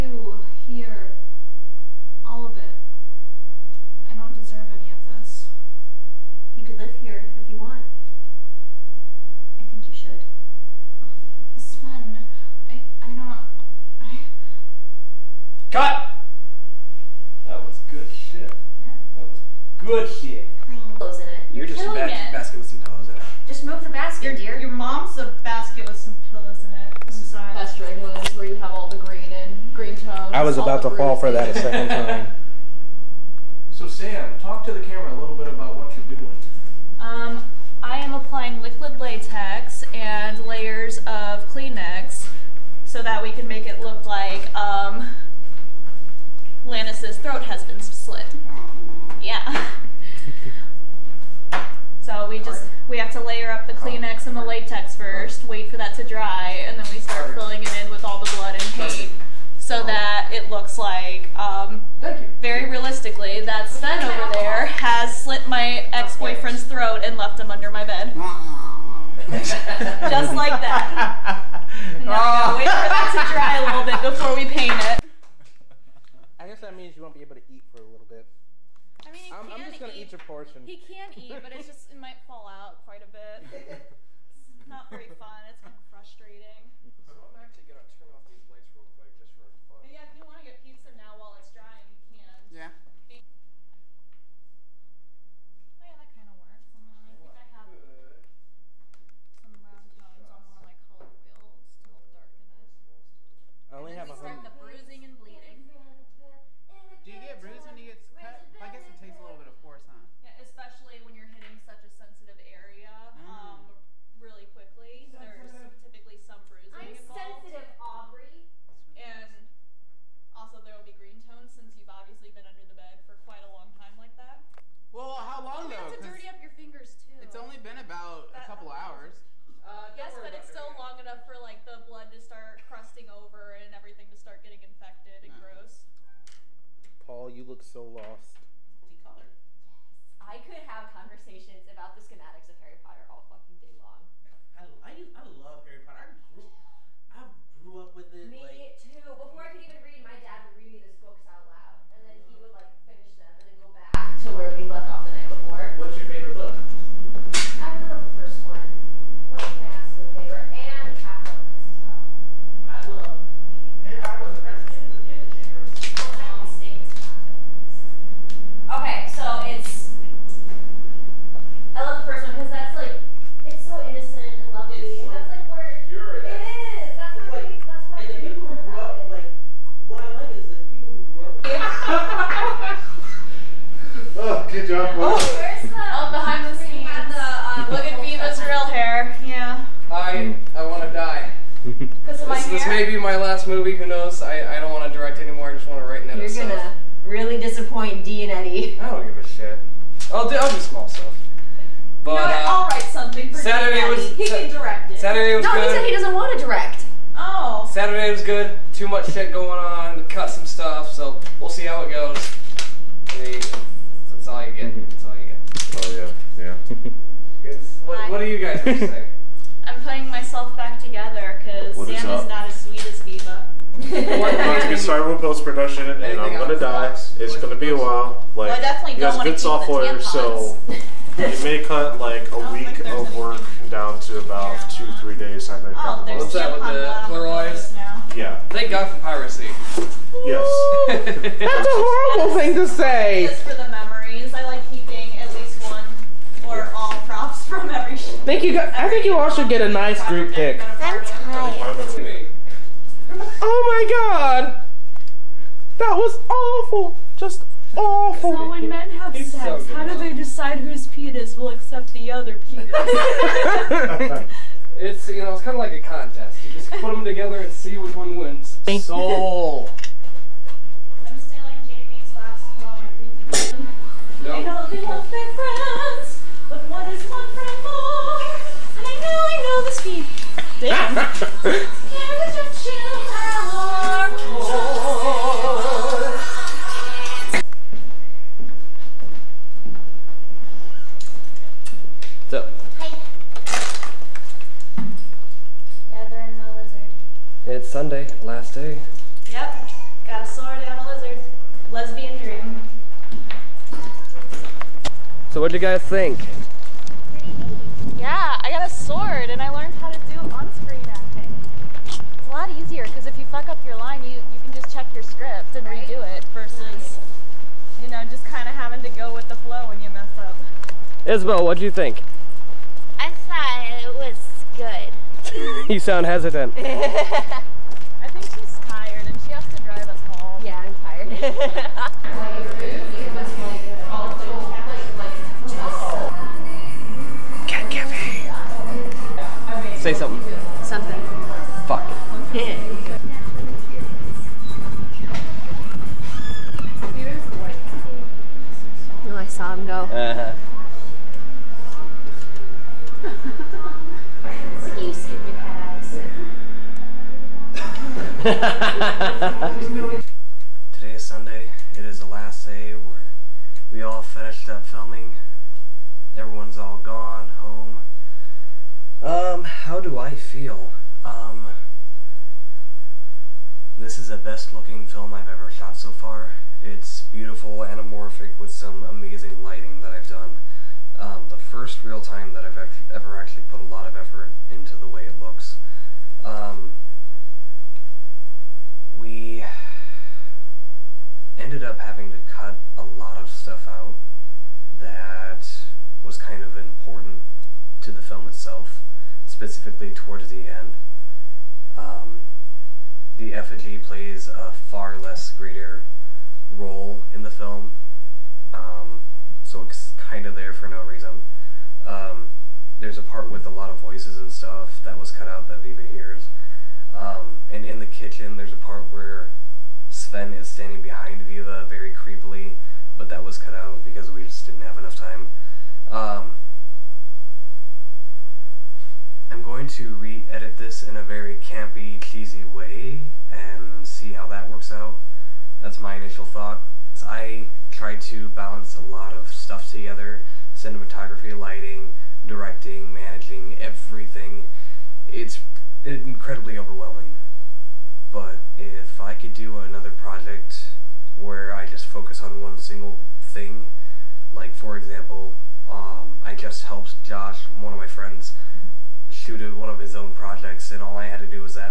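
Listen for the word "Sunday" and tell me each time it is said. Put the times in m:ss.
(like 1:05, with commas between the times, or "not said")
4:57, 6:01.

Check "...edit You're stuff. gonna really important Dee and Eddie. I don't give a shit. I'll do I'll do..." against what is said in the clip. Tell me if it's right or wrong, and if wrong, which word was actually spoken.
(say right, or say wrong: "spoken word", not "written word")
wrong: "disappoint", not "important".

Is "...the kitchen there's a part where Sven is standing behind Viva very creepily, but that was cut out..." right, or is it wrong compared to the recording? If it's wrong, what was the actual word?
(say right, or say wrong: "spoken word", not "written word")
right.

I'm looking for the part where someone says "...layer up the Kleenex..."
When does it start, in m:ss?
0:53.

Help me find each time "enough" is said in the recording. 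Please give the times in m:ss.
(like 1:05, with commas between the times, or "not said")
7:04.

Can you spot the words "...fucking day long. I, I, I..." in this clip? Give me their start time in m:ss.
2:23.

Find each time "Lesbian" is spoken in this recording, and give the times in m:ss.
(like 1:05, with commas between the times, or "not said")
5:01.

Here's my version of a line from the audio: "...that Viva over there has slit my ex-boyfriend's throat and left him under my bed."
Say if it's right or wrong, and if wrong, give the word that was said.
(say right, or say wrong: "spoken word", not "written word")
wrong: "Sven", not "Viva".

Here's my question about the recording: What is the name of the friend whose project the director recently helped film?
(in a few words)
Josh.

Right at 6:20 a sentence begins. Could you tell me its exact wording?
Um, the first real time that I've ever actually put a lot of effort into the way it looks.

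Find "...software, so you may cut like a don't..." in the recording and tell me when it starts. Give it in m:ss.
3:49.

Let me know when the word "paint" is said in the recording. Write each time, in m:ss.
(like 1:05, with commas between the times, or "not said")
0:58, 1:14.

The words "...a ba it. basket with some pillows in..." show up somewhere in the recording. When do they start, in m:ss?
0:21.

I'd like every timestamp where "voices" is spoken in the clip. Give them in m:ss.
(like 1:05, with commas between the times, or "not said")
6:53.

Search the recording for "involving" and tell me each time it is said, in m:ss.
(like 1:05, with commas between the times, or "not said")
not said.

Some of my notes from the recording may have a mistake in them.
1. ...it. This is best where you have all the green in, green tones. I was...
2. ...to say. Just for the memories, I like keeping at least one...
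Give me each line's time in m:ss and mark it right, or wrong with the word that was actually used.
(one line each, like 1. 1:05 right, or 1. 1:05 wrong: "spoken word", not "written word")
1. 0:26 right
2. 4:02 right.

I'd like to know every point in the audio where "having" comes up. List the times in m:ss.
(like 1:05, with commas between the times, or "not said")
5:18, 6:31.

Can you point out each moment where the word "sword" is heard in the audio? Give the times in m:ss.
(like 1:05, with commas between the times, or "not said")
5:00, 5:08.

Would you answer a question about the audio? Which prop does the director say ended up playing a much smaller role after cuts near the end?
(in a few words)
the effigy.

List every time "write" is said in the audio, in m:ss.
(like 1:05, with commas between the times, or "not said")
3:15, 3:22.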